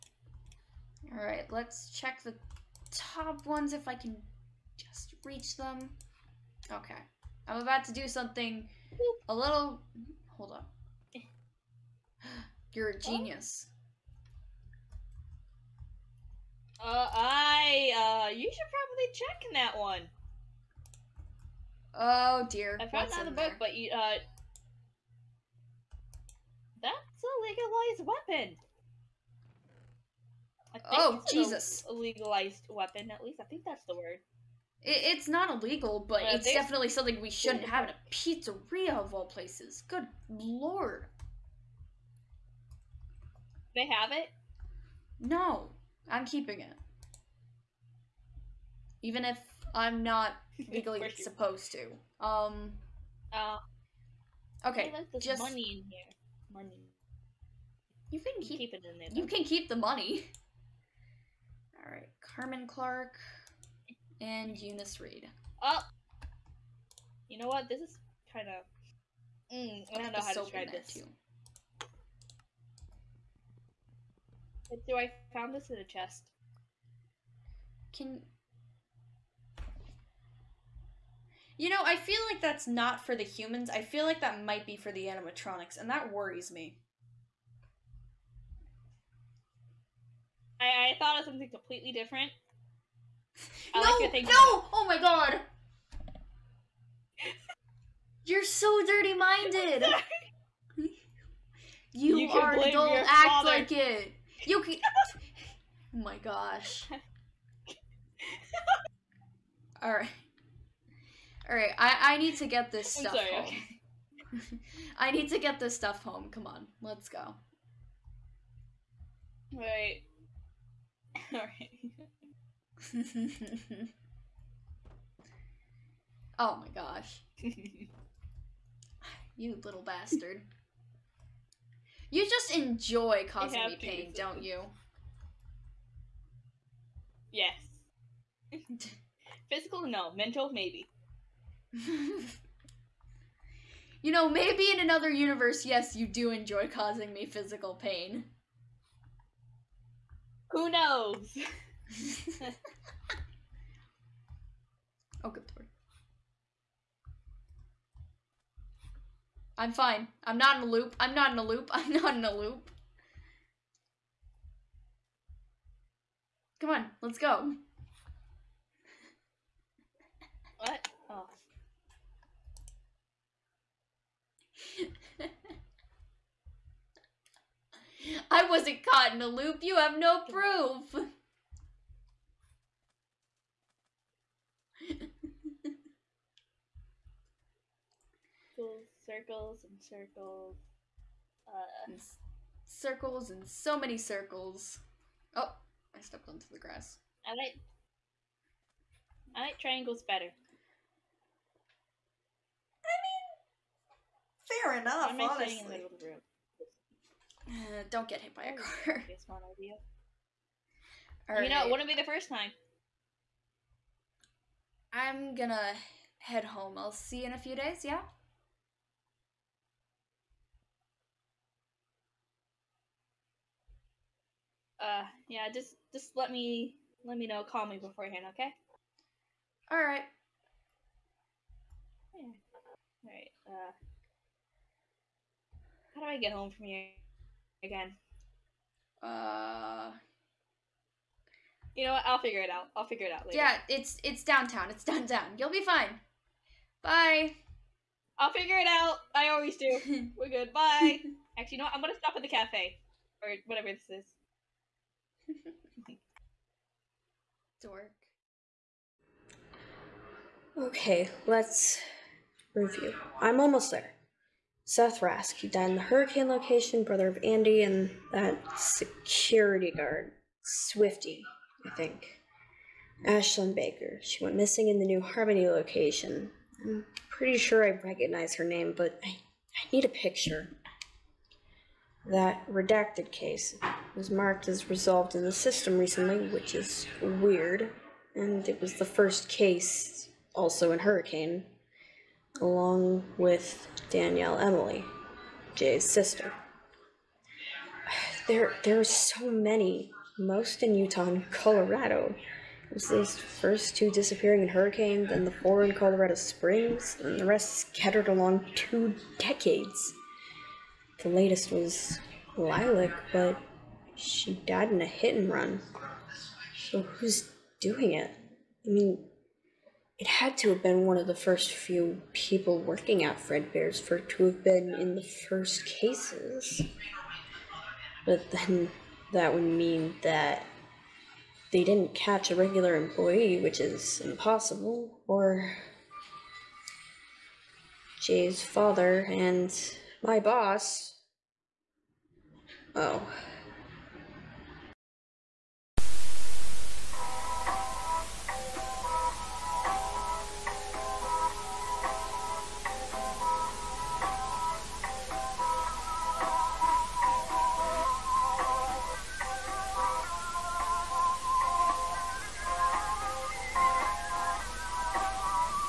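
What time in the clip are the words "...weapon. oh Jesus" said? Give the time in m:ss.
0:30.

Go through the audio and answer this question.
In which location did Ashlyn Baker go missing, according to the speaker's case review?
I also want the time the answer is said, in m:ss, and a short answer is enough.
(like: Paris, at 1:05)
New Harmony, at 4:34.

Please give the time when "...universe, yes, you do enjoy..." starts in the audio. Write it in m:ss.
2:25.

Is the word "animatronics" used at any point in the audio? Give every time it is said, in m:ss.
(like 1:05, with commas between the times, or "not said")
1:25.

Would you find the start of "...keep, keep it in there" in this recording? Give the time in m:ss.
0:58.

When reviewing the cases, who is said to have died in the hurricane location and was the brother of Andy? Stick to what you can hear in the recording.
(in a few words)
Seth Rask.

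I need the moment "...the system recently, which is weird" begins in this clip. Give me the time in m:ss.
4:45.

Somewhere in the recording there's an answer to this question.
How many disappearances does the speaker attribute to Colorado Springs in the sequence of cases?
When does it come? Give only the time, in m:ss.
5:05.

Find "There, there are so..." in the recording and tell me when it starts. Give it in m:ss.
4:58.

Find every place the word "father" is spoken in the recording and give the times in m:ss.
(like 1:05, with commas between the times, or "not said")
1:43, 5:38.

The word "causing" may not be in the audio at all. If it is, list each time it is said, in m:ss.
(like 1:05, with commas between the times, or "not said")
2:13, 2:26.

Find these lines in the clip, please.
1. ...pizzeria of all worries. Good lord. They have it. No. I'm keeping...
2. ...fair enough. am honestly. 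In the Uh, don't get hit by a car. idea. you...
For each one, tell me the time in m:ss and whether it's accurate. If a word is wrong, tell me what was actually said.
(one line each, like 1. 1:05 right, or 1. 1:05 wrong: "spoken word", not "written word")
1. 0:38 wrong: "places", not "worries"
2. 3:24 right.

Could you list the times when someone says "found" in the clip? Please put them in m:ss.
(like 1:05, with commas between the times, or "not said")
0:22, 1:15.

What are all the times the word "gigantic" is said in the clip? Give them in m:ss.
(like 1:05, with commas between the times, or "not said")
not said.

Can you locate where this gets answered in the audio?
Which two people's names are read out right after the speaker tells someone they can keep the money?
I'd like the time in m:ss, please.
1:02.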